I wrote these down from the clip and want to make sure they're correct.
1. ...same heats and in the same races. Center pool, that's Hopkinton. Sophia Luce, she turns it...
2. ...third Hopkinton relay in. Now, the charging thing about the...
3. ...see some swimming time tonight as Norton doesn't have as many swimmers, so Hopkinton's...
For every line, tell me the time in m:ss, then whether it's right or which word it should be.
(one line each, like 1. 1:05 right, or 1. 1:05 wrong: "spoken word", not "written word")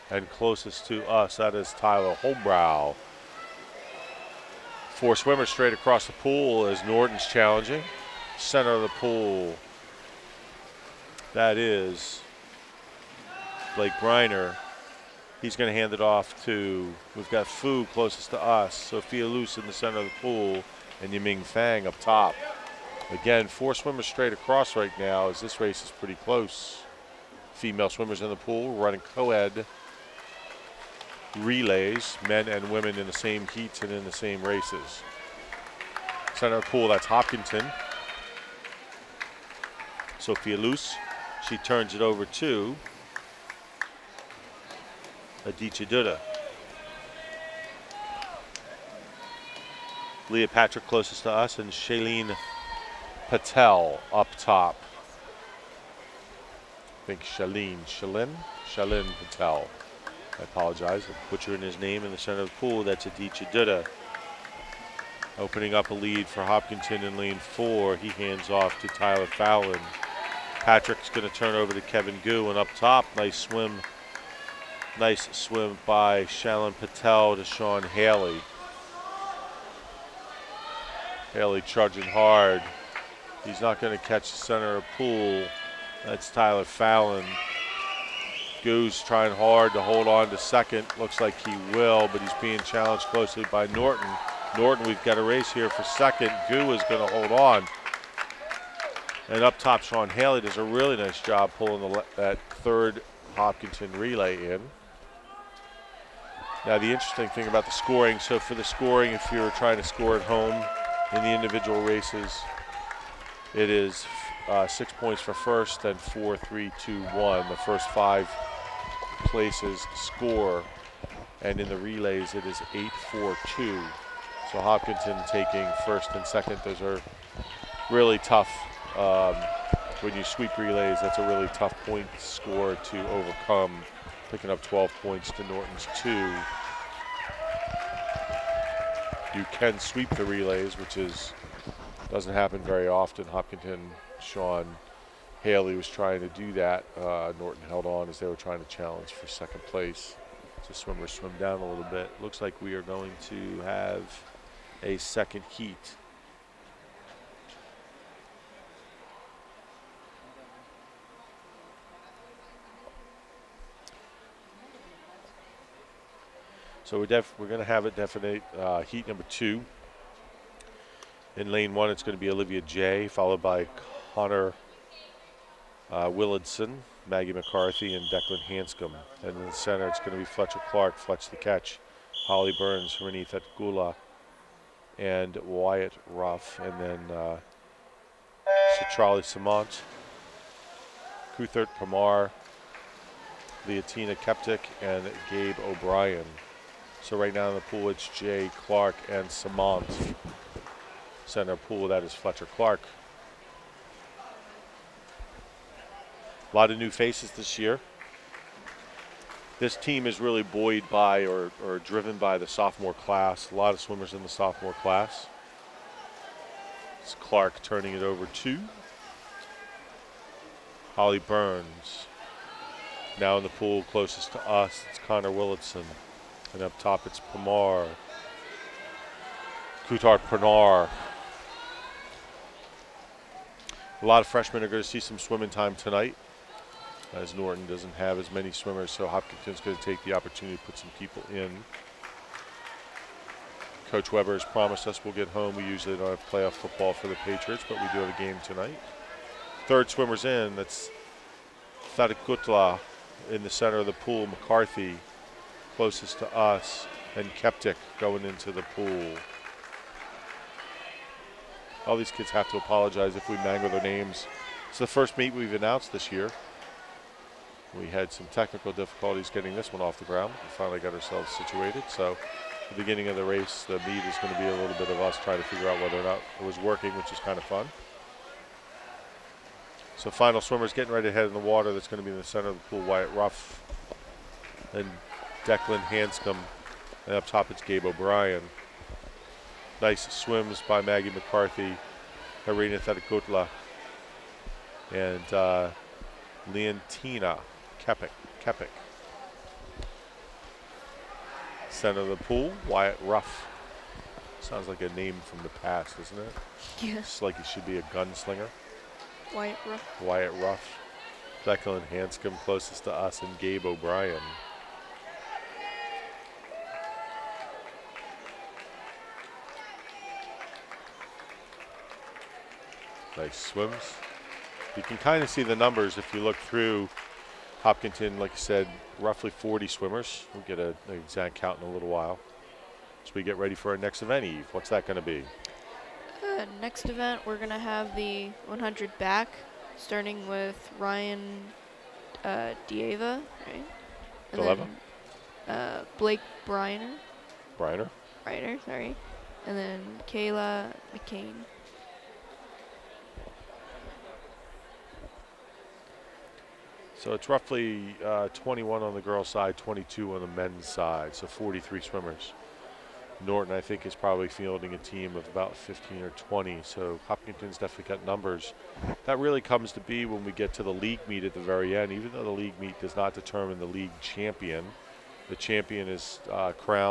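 1. 0:33 right
2. 1:42 wrong: "interesting", not "charging"
3. 3:54 right.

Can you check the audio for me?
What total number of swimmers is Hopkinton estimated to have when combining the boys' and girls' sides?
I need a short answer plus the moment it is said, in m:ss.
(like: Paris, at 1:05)
43, at 6:01.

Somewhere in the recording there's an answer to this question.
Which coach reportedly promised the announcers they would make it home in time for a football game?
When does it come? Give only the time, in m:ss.
4:03.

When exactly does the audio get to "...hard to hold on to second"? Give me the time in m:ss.
1:29.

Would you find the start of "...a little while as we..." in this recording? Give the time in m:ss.
5:31.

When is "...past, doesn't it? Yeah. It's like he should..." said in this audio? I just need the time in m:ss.
5:05.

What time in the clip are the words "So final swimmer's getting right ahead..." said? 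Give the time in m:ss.
4:39.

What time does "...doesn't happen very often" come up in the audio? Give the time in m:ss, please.
2:22.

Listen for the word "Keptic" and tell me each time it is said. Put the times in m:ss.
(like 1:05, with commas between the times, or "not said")
3:14, 4:17.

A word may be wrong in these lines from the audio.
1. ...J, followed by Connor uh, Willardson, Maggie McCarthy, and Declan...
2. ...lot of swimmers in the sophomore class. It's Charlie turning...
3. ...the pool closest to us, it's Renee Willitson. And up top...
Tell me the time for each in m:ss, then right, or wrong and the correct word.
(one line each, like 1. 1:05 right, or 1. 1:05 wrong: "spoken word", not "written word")
1. 2:52 right
2. 3:33 wrong: "Clark", not "Charlie"
3. 3:43 wrong: "Connor", not "Renee".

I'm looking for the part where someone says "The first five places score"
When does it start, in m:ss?
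1:57.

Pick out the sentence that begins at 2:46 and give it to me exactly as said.
So we're, we're going to have it definite uh, heat number two.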